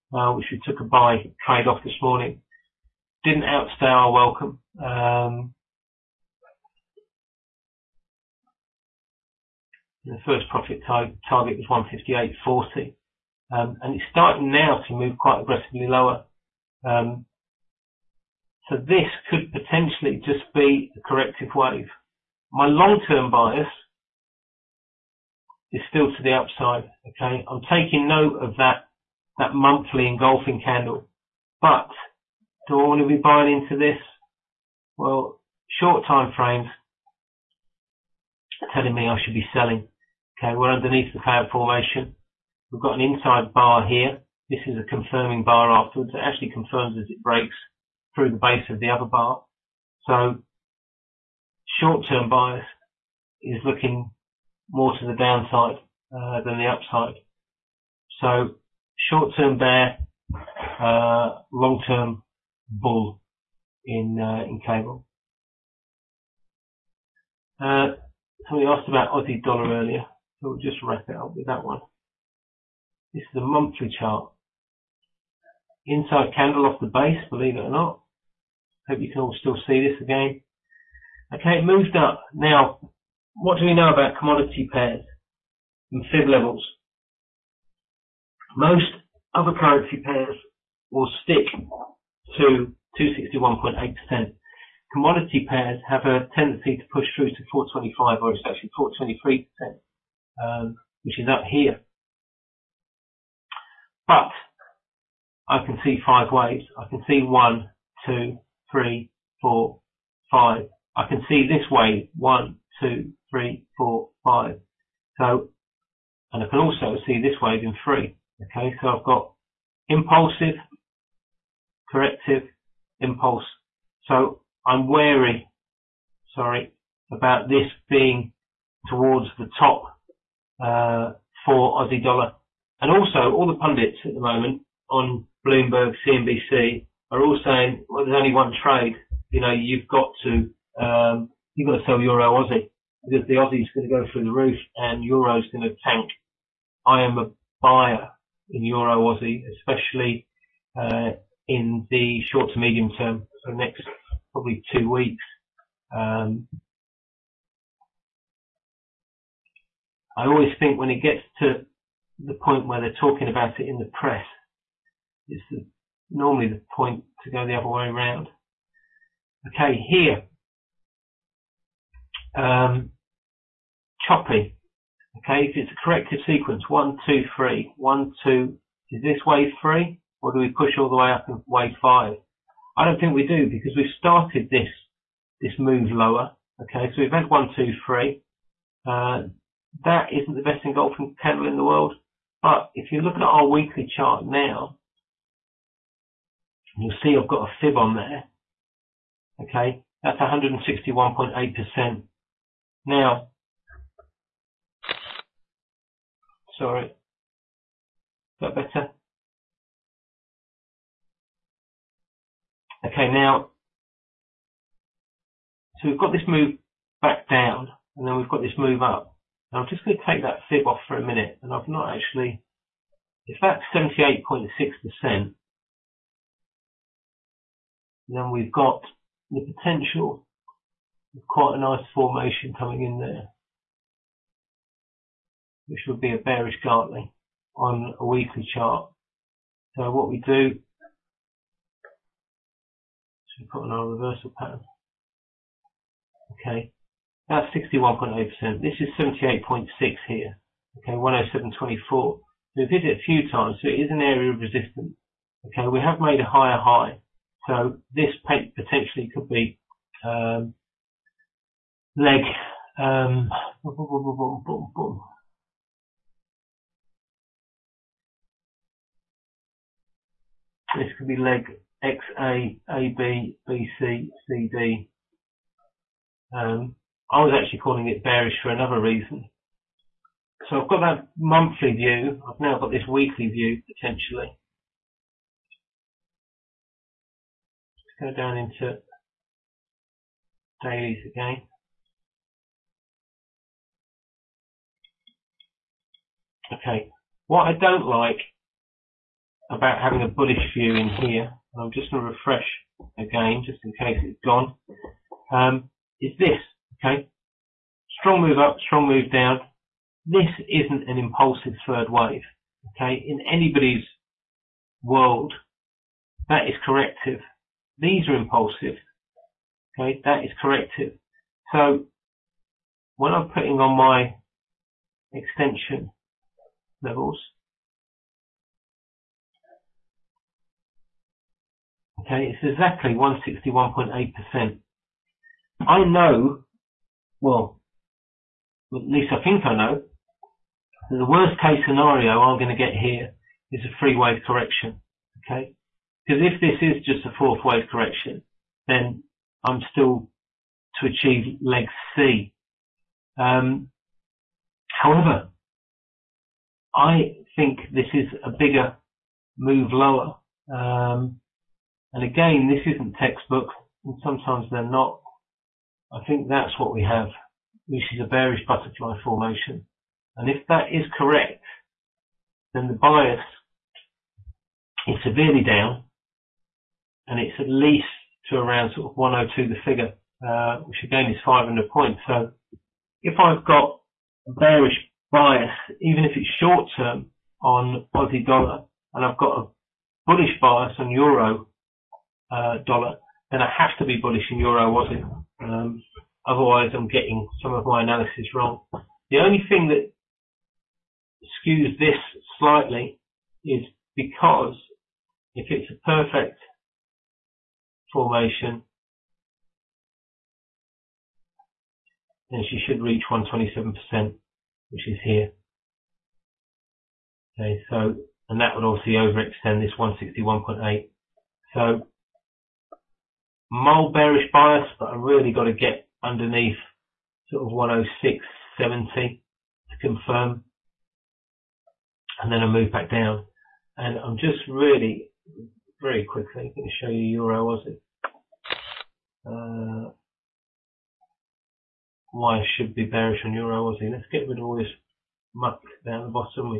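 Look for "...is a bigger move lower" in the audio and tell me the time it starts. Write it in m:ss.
5:57.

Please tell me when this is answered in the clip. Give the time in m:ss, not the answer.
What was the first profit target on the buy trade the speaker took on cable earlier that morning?
0:12.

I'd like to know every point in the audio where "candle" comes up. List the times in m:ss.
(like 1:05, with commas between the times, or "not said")
0:30, 1:16, 3:11.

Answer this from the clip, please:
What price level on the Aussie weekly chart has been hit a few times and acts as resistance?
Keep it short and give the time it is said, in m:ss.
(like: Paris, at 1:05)
107.24, at 4:10.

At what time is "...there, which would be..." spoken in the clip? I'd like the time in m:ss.
3:52.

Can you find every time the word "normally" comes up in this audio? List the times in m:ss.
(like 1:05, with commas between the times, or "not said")
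2:46.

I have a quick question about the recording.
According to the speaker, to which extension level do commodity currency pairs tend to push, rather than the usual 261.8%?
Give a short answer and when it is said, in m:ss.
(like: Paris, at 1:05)
423%, at 1:38.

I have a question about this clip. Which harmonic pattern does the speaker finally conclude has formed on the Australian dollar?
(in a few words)
bearish butterfly.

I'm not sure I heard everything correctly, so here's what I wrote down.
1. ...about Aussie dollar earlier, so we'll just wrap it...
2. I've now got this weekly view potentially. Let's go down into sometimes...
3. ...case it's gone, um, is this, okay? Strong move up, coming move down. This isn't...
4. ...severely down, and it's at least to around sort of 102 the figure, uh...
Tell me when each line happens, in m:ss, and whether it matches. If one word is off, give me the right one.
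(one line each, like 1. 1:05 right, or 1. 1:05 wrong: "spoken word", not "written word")
1. 1:08 right
2. 4:42 wrong: "dailies", not "sometimes"
3. 5:03 wrong: "strong", not "coming"
4. 6:15 right.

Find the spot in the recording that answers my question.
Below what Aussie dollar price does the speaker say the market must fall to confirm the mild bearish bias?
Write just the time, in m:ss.
7:07.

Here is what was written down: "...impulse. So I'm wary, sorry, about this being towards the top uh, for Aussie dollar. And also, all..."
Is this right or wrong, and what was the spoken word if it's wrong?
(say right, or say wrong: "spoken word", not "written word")
right.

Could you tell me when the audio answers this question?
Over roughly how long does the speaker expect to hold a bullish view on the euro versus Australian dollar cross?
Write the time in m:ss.
2:34.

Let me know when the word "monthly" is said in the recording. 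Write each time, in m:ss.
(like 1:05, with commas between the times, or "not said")
0:29, 1:13, 4:41.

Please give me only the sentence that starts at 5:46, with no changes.
Because if this is just a fourth wave correction, then I'm still to achieve leg C.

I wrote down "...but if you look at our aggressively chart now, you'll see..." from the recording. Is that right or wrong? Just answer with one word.
wrong.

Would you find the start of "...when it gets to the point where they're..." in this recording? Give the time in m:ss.
2:40.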